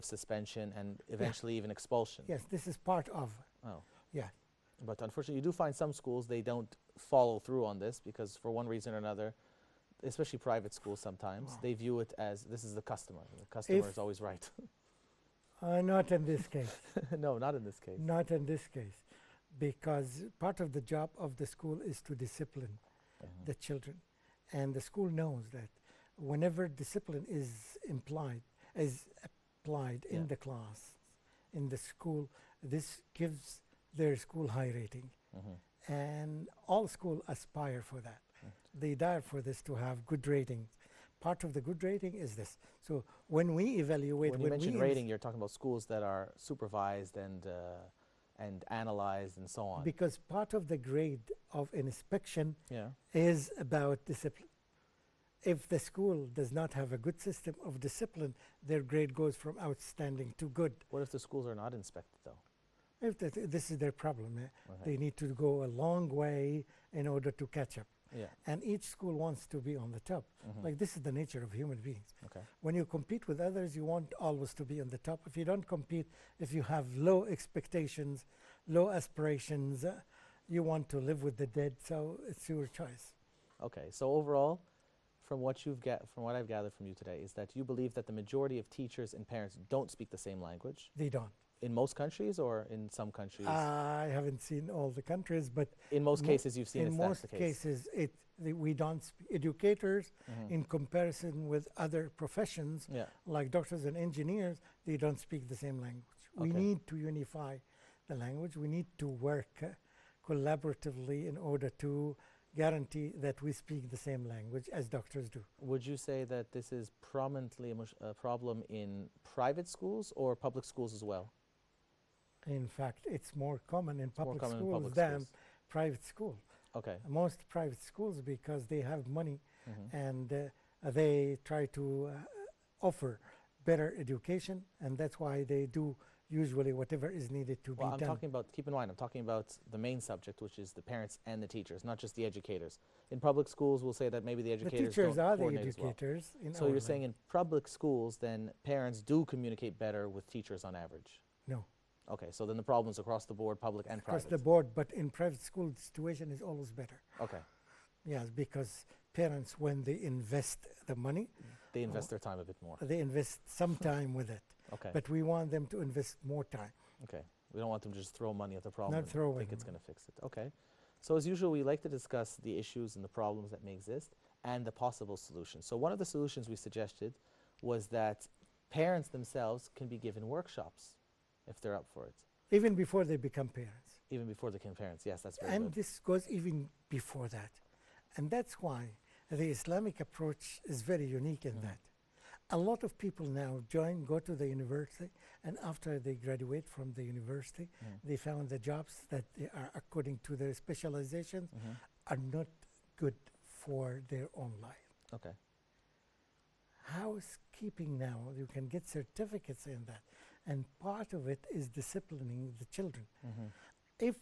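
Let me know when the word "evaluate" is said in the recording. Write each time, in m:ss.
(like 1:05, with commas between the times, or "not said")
0:43.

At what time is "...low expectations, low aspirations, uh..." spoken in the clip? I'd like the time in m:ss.
1:16.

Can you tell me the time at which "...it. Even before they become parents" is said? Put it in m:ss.
3:02.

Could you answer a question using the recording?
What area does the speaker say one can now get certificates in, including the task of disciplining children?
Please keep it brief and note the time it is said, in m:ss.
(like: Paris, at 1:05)
Housekeeping, at 3:26.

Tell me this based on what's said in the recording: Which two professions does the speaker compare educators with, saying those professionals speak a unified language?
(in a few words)
Doctors and engineers.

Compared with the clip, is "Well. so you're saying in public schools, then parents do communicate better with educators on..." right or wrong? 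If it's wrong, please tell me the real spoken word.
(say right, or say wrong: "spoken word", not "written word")
wrong: "teachers", not "educators".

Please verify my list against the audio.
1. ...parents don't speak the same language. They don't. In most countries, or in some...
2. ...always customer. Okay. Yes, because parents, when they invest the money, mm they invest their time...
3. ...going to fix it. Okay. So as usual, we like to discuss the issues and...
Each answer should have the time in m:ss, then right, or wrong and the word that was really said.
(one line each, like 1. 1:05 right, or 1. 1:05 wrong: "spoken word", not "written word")
1. 1:29 right
2. 2:36 wrong: "better", not "customer"
3. 2:49 right.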